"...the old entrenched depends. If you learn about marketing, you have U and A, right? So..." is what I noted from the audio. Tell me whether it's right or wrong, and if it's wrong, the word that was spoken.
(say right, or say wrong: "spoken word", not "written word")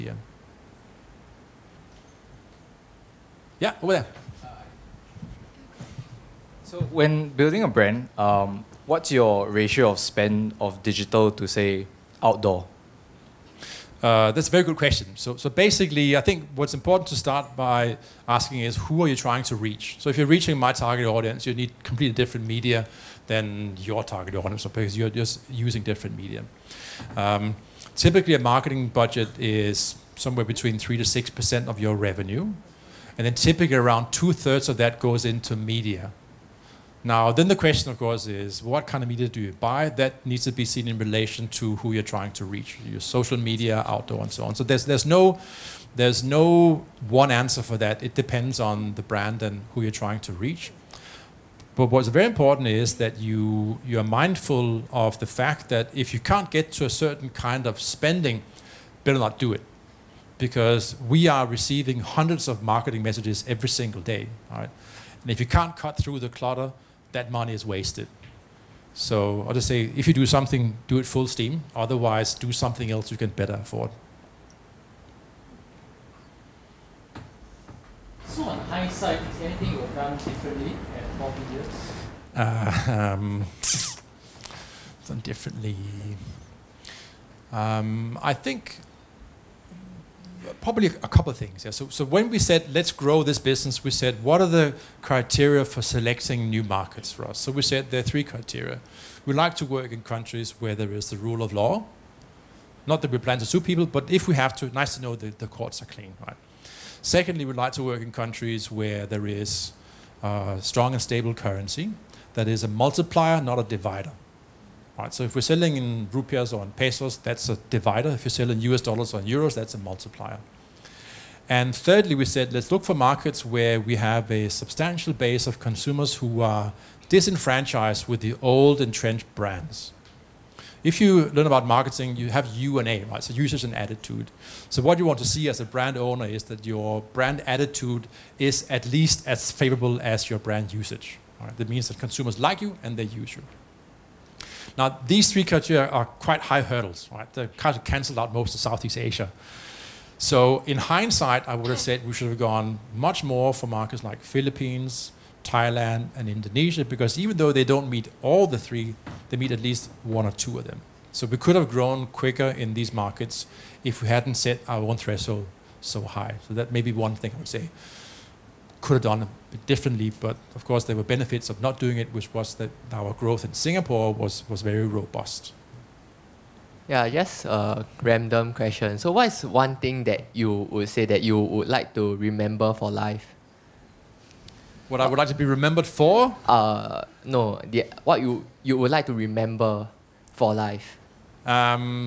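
wrong: "brands", not "depends".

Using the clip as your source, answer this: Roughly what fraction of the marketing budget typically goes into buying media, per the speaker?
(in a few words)
two thirds.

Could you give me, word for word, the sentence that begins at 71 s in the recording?
Otherwise, do something else you can better afford.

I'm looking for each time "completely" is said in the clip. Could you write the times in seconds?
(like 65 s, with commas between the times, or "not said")
21 s.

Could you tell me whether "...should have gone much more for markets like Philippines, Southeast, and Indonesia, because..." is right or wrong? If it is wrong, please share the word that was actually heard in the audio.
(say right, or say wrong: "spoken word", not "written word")
wrong: "Thailand", not "Southeast".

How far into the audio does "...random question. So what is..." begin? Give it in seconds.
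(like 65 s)
177 s.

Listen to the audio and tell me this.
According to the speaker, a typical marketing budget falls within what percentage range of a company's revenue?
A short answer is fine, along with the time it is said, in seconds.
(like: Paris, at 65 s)
3 to 6%, at 30 s.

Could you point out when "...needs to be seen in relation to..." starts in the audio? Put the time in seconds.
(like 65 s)
40 s.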